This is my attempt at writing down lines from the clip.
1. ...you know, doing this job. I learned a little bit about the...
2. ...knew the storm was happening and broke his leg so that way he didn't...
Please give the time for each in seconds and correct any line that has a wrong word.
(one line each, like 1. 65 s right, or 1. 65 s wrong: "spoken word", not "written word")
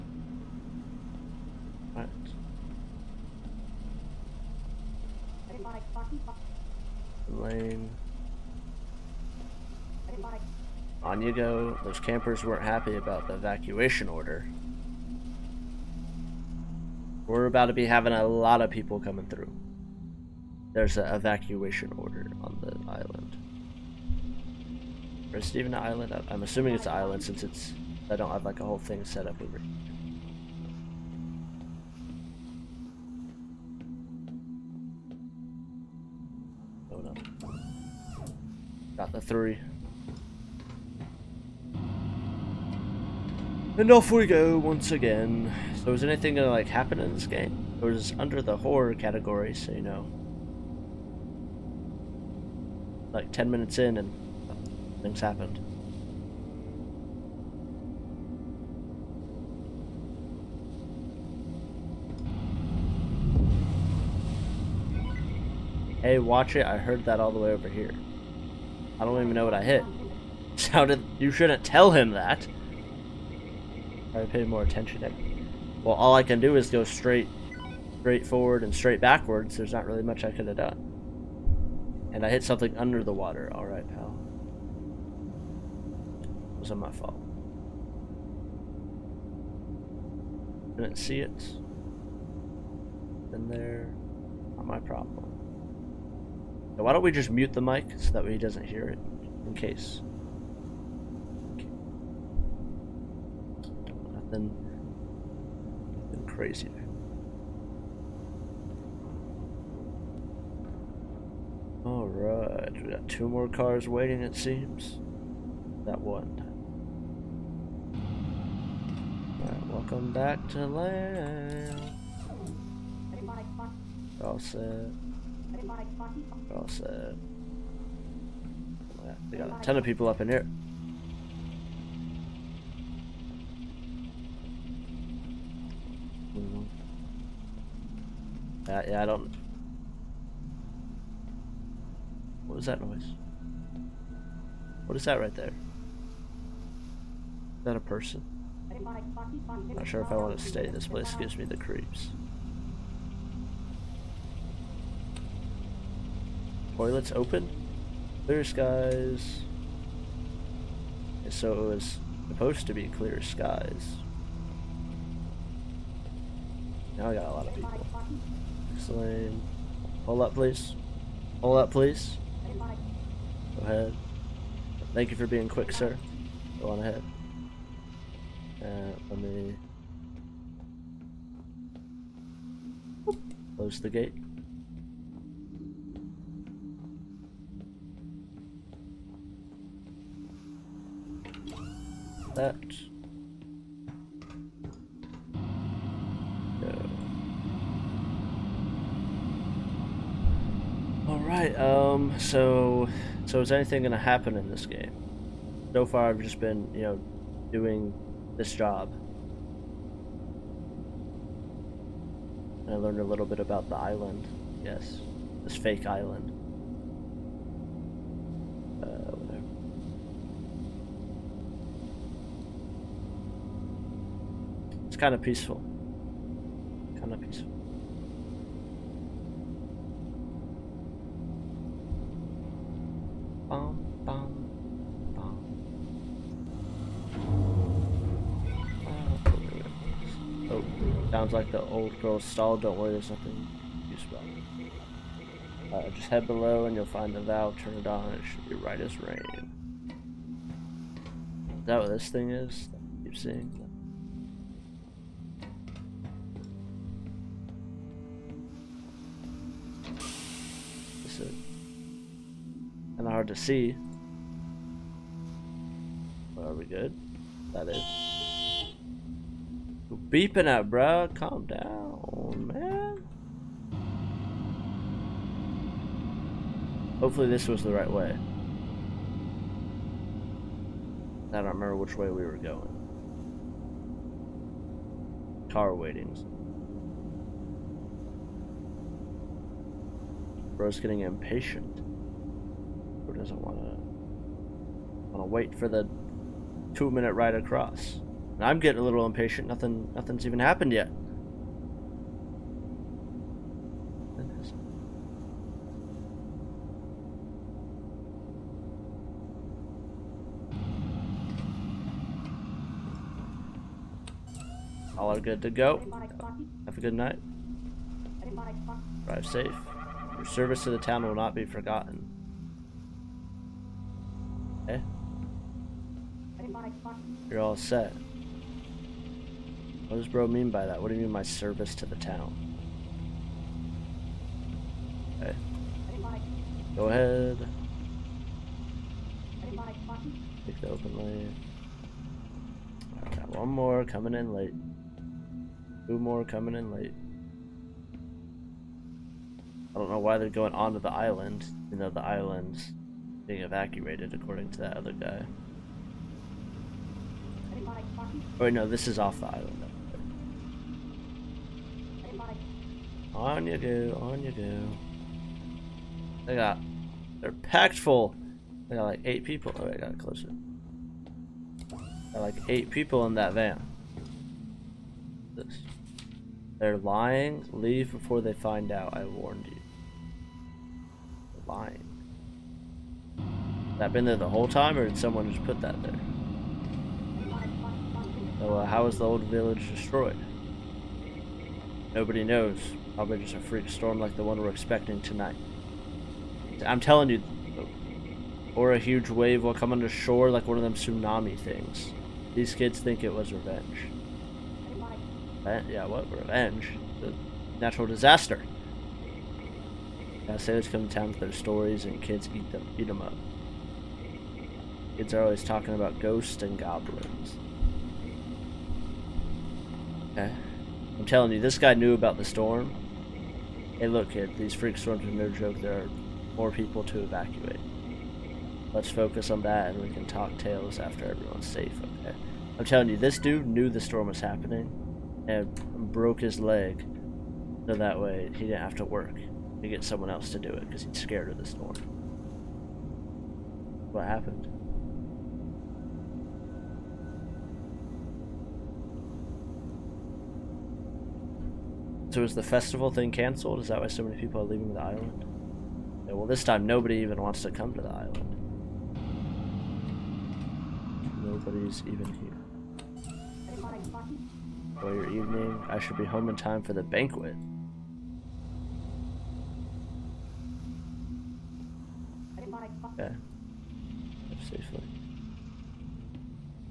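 1. 206 s right
2. 433 s right.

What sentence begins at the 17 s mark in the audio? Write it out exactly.
We're about to be having a lot of people coming through.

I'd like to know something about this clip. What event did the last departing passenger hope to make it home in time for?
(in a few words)
The banquet.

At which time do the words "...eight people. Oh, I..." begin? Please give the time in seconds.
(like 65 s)
369 s.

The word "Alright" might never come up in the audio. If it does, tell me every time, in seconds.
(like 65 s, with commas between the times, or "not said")
1 s, 111 s, 119 s.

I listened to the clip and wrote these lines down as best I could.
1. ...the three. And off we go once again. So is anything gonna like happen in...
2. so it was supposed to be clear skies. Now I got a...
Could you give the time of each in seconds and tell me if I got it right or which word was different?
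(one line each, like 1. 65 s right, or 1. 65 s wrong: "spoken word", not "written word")
1. 39 s right
2. 161 s right.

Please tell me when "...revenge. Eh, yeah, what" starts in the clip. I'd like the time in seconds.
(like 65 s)
403 s.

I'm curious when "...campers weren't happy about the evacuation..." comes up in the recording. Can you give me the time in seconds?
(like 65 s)
11 s.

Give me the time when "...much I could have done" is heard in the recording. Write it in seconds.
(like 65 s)
80 s.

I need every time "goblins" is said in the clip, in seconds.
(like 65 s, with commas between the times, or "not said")
416 s.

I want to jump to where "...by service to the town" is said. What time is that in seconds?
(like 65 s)
331 s.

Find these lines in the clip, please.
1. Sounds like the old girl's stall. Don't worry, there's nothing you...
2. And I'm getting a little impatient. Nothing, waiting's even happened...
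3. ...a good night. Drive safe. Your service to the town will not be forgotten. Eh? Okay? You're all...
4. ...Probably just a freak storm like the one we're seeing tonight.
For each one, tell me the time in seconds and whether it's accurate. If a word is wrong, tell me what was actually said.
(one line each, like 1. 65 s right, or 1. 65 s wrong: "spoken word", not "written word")
1. 241 s right
2. 298 s wrong: "nothing", not "waiting"
3. 316 s right
4. 392 s wrong: "expecting", not "seeing".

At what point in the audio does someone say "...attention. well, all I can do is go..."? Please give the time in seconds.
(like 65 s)
74 s.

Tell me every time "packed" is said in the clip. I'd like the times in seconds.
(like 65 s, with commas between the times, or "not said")
367 s.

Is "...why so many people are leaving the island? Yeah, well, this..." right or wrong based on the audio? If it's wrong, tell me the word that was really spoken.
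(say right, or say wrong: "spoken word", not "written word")
right.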